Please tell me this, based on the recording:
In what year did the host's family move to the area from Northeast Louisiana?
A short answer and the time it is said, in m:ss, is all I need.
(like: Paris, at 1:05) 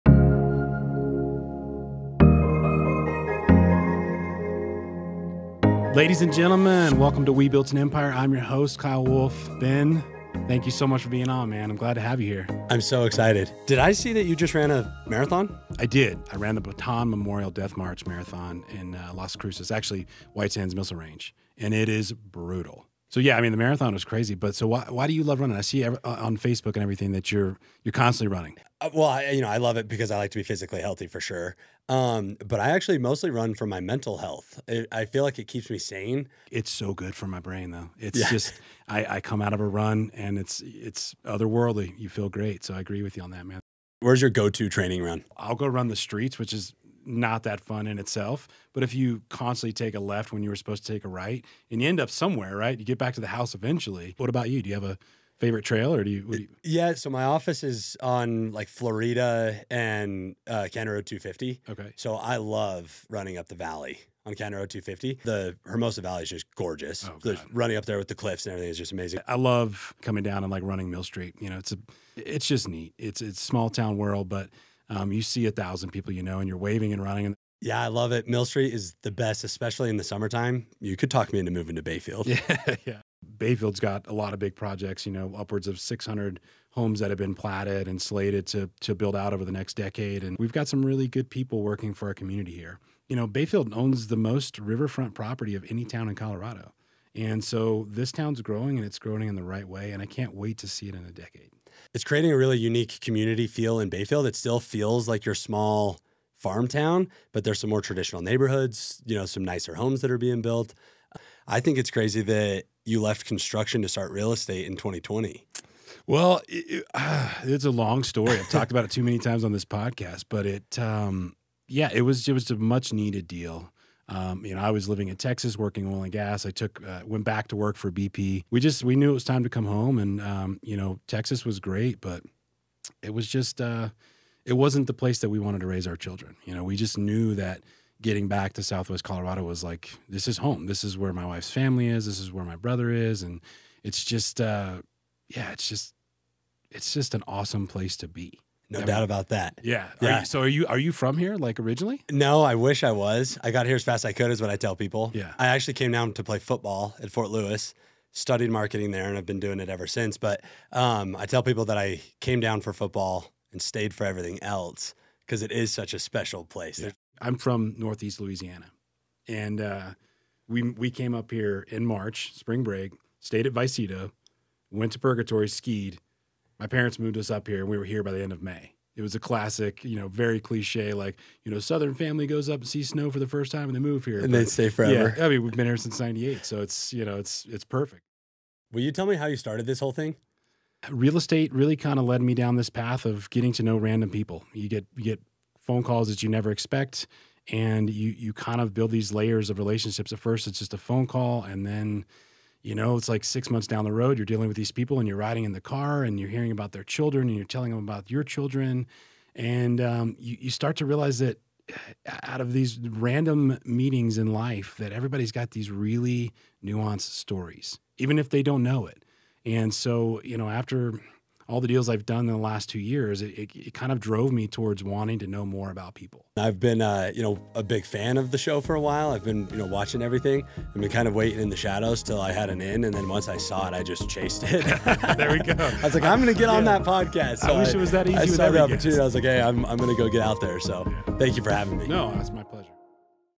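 1998, at 3:05.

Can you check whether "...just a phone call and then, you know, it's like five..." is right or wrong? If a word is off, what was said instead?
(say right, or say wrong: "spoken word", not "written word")
wrong: "six", not "five".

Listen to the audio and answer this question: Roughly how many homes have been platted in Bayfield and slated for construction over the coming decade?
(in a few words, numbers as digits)
600.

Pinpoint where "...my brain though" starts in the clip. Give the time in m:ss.
0:37.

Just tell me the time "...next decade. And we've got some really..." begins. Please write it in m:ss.
1:29.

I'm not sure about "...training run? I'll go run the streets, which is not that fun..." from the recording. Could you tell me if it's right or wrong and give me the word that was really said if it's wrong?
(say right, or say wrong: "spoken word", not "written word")
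right.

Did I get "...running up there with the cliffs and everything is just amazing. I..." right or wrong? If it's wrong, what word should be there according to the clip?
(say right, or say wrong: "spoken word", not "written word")
right.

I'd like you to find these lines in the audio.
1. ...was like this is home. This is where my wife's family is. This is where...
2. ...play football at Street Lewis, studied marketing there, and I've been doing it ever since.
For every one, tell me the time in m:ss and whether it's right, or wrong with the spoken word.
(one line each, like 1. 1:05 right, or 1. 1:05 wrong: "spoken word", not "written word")
1. 2:19 right
2. 2:36 wrong: "Fort", not "Street".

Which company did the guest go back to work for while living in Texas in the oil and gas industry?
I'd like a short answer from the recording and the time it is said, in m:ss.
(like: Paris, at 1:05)
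BP, at 2:07.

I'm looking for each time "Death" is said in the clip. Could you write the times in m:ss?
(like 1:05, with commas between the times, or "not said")
0:17.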